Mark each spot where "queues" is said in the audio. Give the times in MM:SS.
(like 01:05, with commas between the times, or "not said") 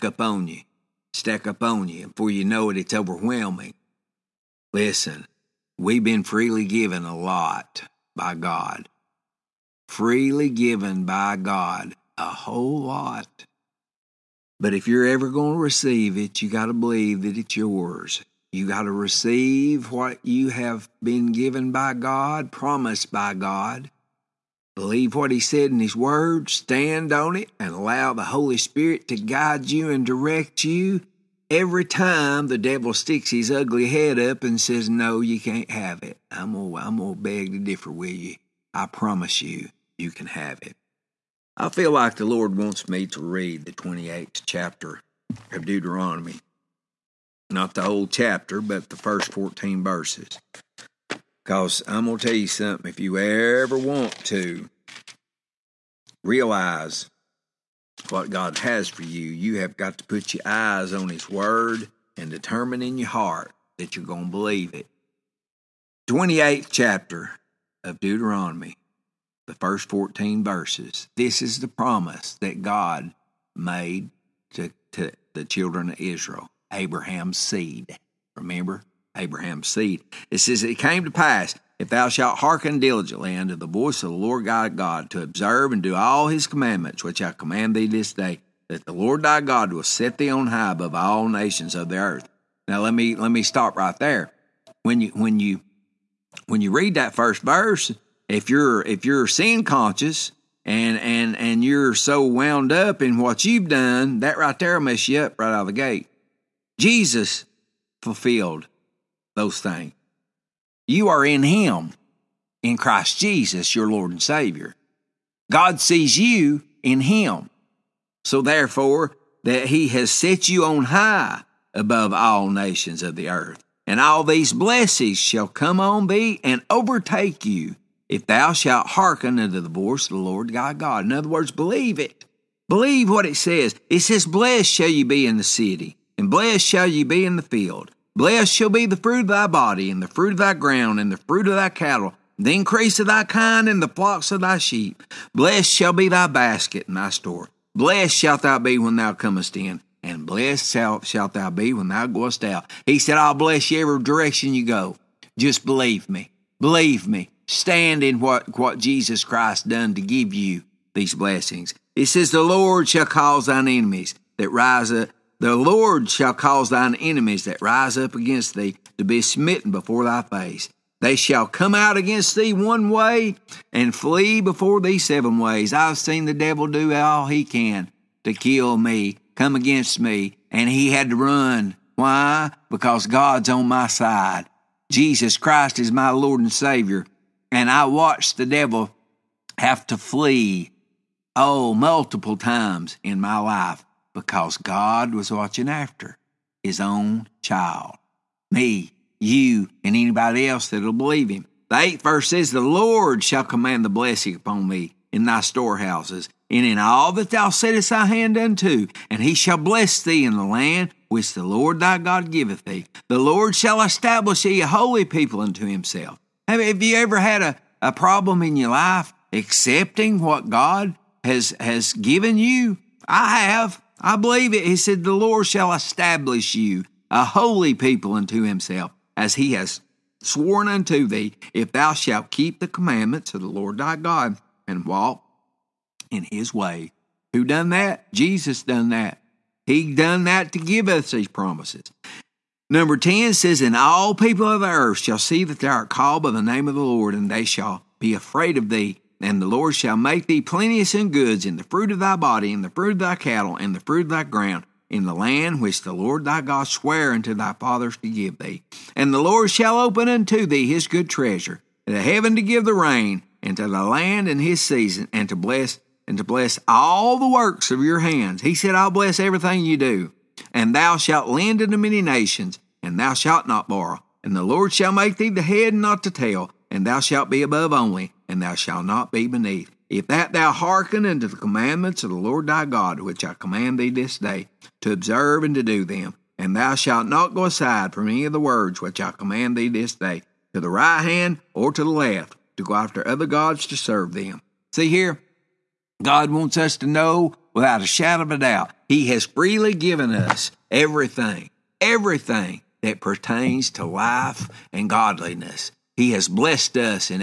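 not said.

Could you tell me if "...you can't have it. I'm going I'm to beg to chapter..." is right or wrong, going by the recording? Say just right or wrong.
wrong.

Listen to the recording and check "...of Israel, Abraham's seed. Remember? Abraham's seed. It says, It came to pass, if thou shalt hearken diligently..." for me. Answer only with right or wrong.
right.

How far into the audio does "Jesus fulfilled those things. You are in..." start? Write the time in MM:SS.
01:46.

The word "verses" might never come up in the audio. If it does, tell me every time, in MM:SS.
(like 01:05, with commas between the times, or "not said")
00:49, 01:10, 01:37, 03:22.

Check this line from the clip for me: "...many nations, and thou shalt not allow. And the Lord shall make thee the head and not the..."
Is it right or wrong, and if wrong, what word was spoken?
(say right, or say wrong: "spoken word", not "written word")
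wrong: "borrow", not "allow".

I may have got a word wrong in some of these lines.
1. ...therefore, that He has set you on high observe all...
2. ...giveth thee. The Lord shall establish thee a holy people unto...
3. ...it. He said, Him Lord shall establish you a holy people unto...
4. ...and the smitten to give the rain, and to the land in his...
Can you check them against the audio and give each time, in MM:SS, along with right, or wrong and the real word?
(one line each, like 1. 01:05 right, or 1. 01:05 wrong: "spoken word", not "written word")
1. 01:58 wrong: "above", not "observe"
2. 03:32 right
3. 03:44 wrong: "The", not "Him"
4. 04:21 wrong: "heaven", not "smitten".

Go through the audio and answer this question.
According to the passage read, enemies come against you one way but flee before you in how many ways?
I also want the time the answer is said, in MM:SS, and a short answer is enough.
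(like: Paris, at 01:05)
7, at 02:54.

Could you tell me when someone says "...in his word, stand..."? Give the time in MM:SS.
00:25.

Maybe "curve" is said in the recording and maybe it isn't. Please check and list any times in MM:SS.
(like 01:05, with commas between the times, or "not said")
not said.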